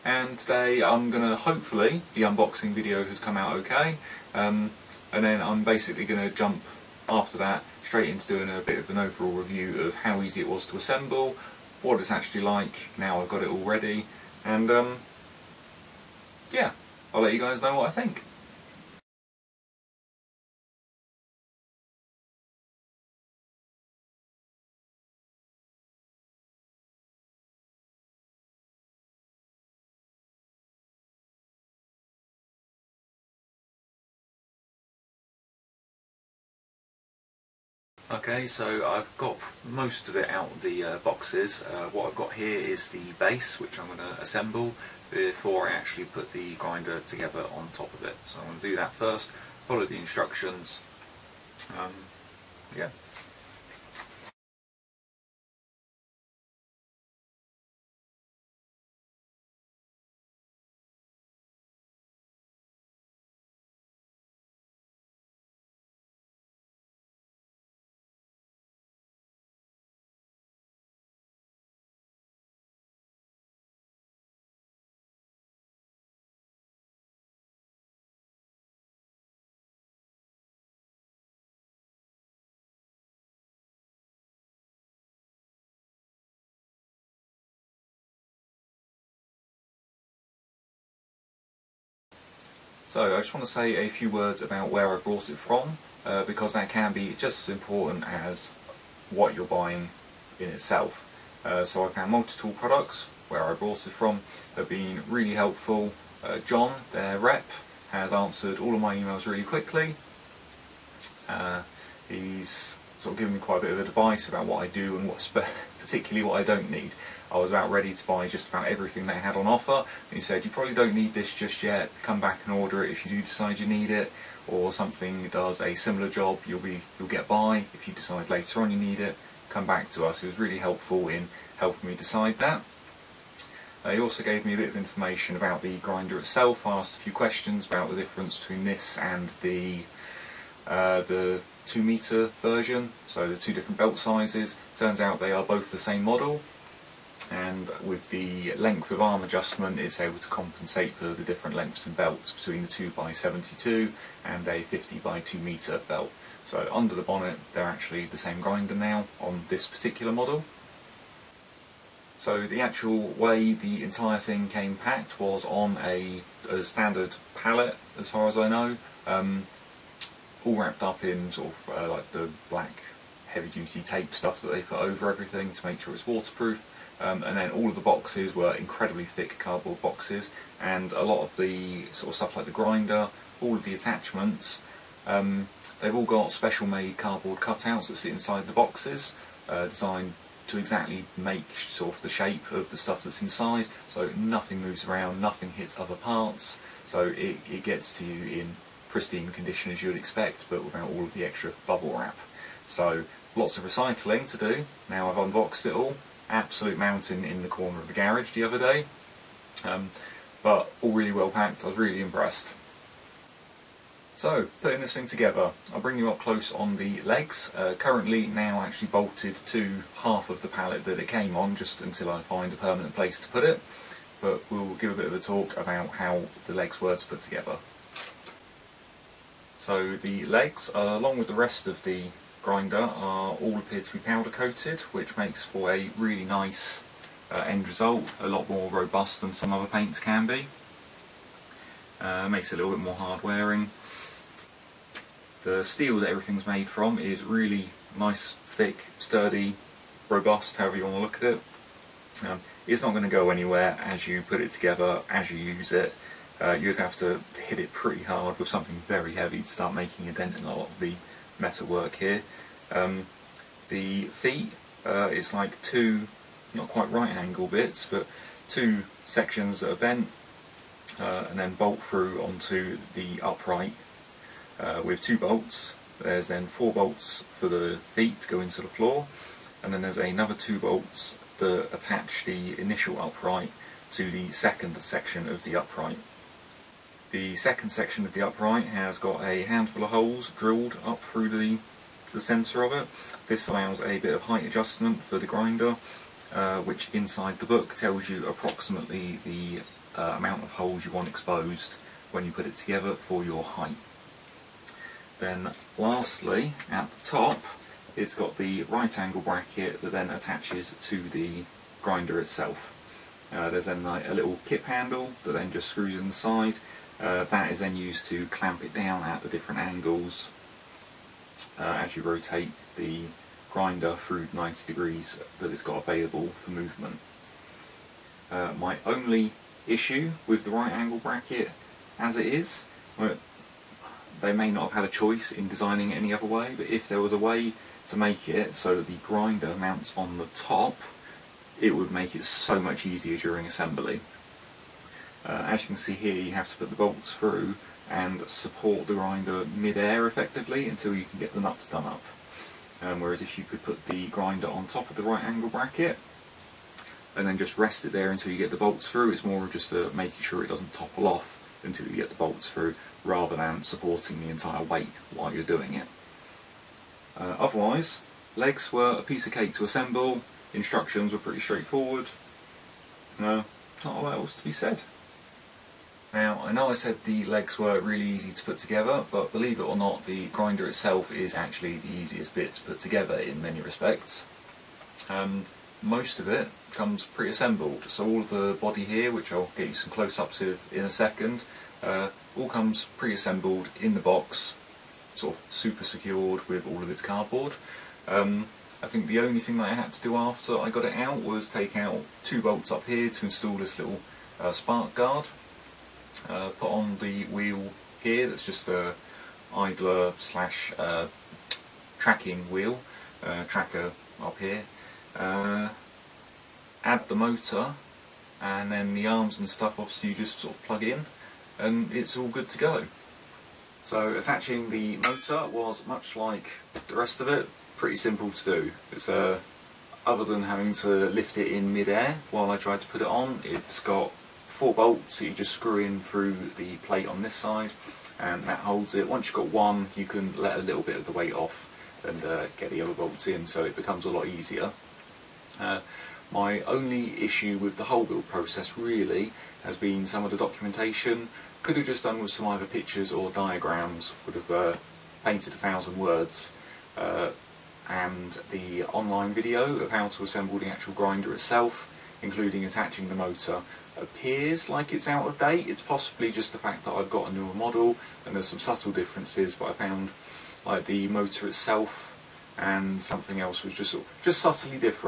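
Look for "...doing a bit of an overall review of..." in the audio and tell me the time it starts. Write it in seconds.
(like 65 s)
8 s.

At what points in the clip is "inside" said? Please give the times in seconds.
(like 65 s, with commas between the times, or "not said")
188 s, 193 s, 296 s, 315 s.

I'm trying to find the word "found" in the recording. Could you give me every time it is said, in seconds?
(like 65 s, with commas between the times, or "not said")
101 s, 469 s.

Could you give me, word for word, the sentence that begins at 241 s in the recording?
Uh, makes it a little bit more hard wearing.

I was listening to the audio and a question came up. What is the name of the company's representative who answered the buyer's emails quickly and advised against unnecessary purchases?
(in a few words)
John.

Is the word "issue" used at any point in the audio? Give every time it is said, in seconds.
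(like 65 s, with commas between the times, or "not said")
329 s, 447 s.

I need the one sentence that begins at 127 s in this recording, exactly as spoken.
If you decide later on you need it, come back to us.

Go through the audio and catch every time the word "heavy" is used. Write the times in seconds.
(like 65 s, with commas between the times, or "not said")
173 s, 259 s.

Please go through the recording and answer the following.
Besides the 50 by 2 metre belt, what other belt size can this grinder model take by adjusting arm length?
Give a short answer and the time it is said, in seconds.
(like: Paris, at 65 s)
2x72, at 152 s.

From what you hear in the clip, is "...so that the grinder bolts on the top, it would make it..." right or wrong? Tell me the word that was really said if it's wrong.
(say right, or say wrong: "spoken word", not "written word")
wrong: "mounts", not "bolts".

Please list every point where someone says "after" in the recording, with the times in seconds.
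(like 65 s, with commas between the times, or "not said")
7 s, 400 s.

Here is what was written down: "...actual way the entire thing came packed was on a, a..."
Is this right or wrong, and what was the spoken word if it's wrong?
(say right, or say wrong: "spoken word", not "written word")
right.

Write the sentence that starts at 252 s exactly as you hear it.
Um, it's not going to go anywhere as you put it together, as you use it.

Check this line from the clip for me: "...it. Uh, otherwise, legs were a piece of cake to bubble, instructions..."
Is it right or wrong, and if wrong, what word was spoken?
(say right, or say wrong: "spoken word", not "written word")
wrong: "assemble", not "bubble".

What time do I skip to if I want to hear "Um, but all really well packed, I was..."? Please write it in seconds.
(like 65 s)
209 s.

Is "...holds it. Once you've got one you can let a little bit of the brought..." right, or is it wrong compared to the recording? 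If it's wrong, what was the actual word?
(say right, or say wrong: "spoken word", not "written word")
wrong: "weight", not "brought".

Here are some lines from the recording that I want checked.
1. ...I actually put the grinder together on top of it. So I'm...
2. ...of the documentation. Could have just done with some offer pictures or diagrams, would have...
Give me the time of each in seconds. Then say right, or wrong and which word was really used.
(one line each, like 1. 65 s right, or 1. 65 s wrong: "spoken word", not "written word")
1. 45 s right
2. 450 s wrong: "either", not "offer".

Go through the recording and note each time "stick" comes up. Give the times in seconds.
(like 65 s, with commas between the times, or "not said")
not said.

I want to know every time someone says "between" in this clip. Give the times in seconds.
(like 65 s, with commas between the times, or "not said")
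138 s, 152 s.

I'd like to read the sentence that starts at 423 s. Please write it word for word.
So attaching the motor was much like the rest of it, pretty simple to do.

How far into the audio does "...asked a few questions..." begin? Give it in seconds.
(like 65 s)
136 s.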